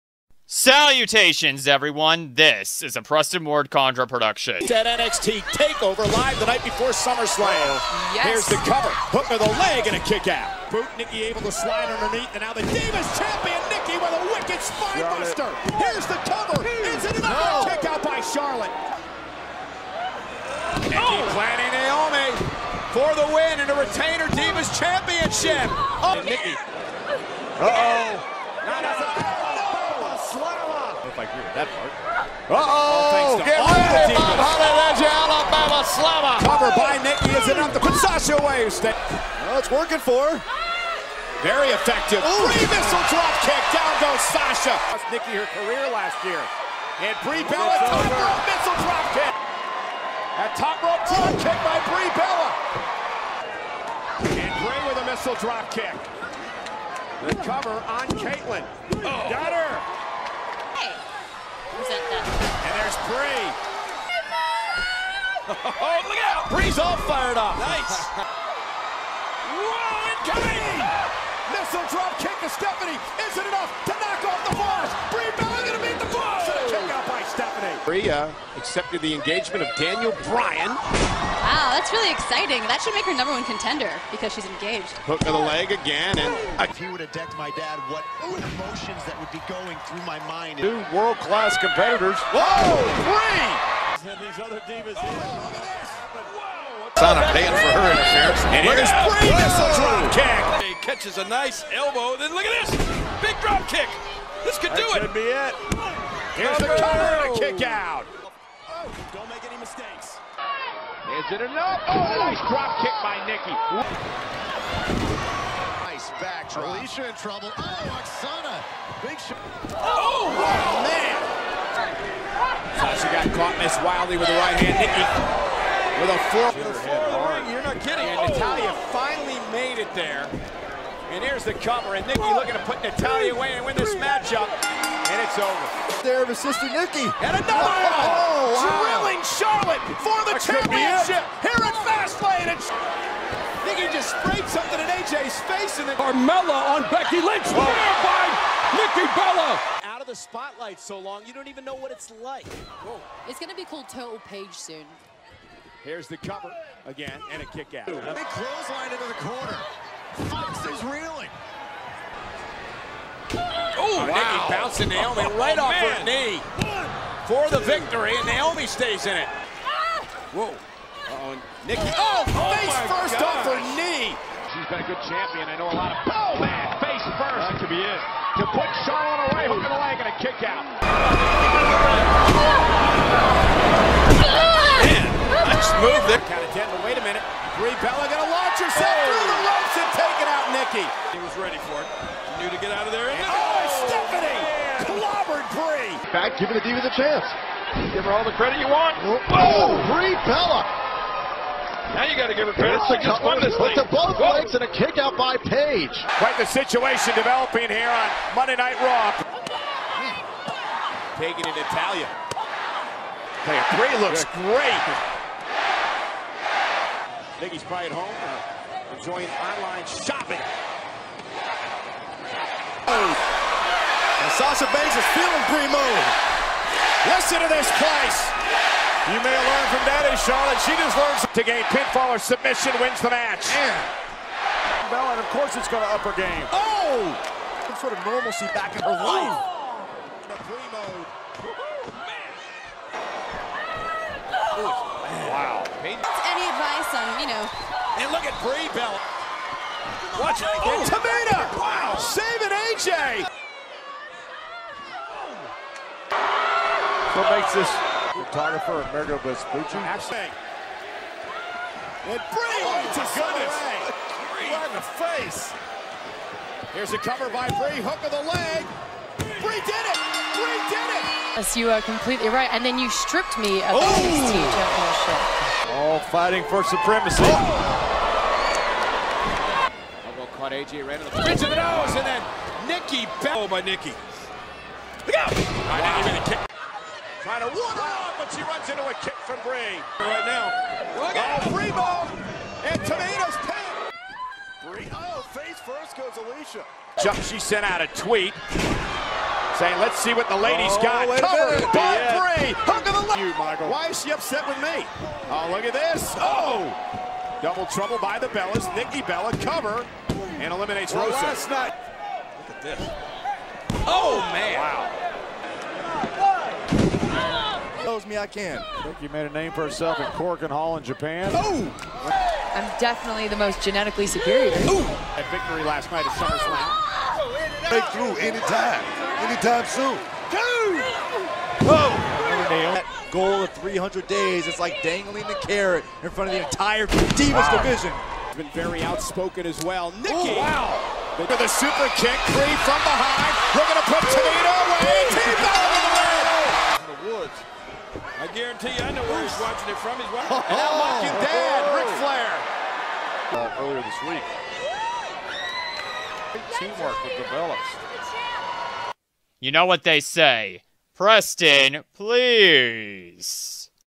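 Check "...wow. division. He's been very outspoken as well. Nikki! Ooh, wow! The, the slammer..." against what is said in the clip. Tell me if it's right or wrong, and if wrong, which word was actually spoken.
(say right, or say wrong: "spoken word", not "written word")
wrong: "super", not "slammer".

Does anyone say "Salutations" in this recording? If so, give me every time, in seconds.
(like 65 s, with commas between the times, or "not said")
0 s.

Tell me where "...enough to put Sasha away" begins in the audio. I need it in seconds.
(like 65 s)
37 s.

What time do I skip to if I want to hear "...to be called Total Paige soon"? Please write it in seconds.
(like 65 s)
153 s.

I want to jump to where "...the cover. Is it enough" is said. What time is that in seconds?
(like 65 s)
16 s.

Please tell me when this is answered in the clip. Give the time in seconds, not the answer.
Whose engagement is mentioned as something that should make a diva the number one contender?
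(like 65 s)
79 s.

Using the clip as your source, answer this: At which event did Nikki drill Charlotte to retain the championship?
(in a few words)
Fastlane.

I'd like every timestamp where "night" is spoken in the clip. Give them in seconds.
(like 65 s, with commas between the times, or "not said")
6 s, 208 s, 311 s, 325 s.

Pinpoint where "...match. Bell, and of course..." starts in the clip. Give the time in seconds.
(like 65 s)
233 s.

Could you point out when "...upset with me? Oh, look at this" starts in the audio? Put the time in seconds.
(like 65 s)
304 s.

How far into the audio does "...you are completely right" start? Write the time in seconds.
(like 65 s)
271 s.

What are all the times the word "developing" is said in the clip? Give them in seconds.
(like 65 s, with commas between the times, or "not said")
207 s.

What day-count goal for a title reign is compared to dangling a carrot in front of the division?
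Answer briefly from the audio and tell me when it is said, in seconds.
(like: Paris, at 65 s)
300 days, at 333 s.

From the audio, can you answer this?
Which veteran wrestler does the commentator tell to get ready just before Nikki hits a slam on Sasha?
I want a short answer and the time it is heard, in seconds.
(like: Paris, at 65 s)
Bob Holly, at 34 s.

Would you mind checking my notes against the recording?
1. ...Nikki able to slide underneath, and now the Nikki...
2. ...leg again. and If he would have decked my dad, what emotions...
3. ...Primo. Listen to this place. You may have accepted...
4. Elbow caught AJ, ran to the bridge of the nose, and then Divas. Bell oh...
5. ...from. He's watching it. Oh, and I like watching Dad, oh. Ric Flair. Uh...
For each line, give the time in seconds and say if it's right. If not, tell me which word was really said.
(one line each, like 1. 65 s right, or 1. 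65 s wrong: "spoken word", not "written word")
1. 10 s wrong: "Divas", not "Nikki"
2. 85 s right
3. 225 s wrong: "learned", not "accepted"
4. 280 s wrong: "Nikki", not "Divas"
5. 349 s right.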